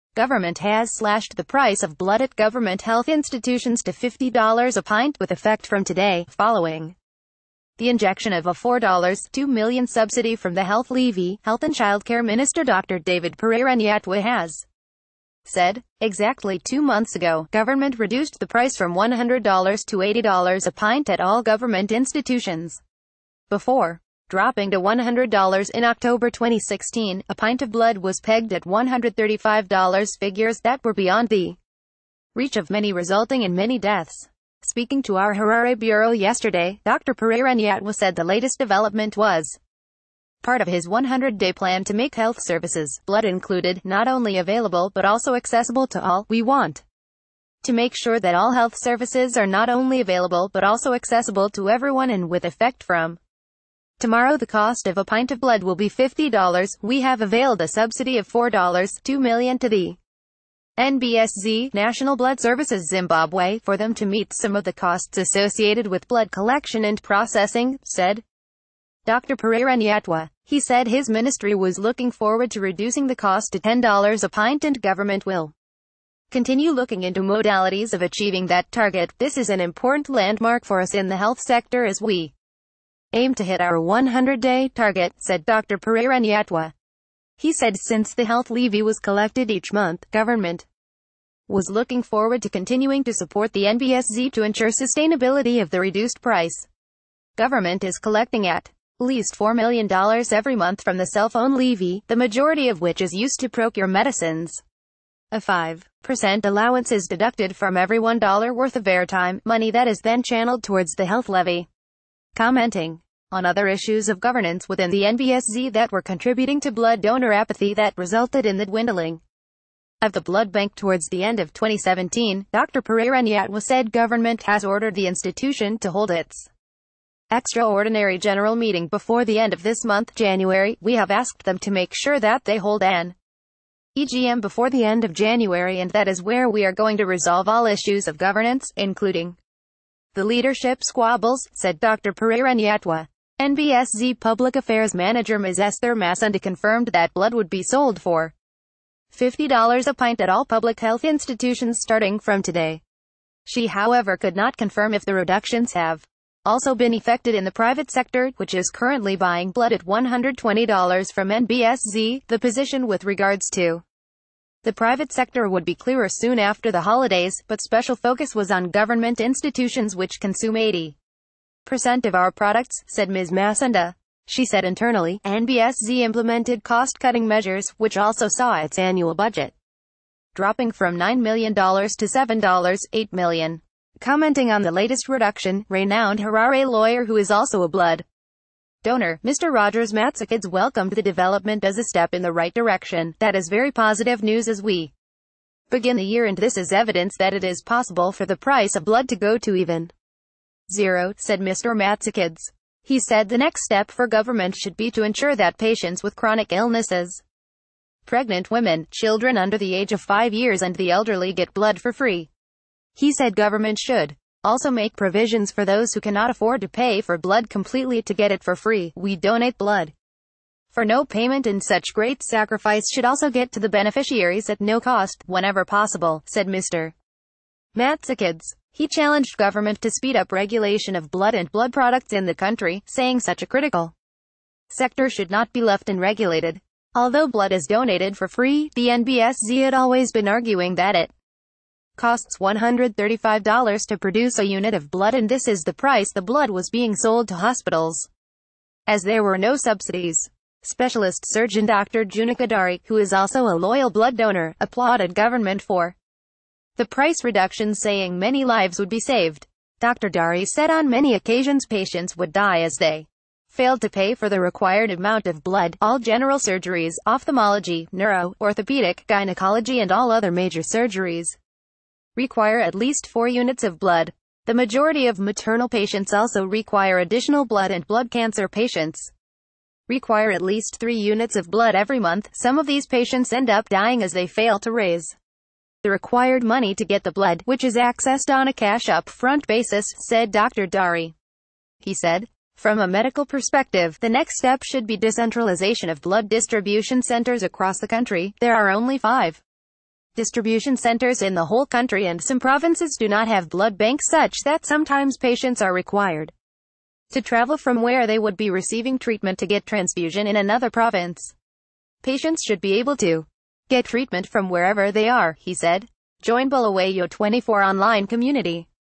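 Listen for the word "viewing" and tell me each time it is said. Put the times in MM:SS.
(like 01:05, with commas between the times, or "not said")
not said.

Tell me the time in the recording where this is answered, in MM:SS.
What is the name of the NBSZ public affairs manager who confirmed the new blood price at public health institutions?
02:25.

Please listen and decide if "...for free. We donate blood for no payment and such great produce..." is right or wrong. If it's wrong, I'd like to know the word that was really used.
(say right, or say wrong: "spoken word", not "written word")
wrong: "sacrifice", not "produce".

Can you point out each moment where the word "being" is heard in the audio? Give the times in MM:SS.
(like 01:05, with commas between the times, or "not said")
04:06.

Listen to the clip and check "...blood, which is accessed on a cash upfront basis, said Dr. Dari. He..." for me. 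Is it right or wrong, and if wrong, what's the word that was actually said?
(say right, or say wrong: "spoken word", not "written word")
right.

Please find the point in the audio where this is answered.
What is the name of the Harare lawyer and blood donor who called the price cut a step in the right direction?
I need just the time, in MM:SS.
03:09.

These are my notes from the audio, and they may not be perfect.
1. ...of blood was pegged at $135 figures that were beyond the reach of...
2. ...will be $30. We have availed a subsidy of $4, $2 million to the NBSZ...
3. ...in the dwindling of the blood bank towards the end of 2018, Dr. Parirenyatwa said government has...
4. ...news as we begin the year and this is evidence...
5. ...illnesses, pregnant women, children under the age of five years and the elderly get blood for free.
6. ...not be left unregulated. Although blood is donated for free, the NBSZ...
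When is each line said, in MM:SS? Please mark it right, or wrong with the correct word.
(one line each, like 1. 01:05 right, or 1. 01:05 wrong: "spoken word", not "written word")
1. 00:27 right
2. 00:55 wrong: "50", not "30"
3. 01:58 wrong: "2017", not "2018"
4. 03:14 right
5. 03:26 right
6. 03:55 right.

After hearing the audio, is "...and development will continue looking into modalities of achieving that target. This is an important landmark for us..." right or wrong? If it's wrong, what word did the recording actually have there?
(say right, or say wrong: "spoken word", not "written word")
wrong: "government", not "development".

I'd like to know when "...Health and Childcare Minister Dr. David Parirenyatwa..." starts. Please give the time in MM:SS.
00:11.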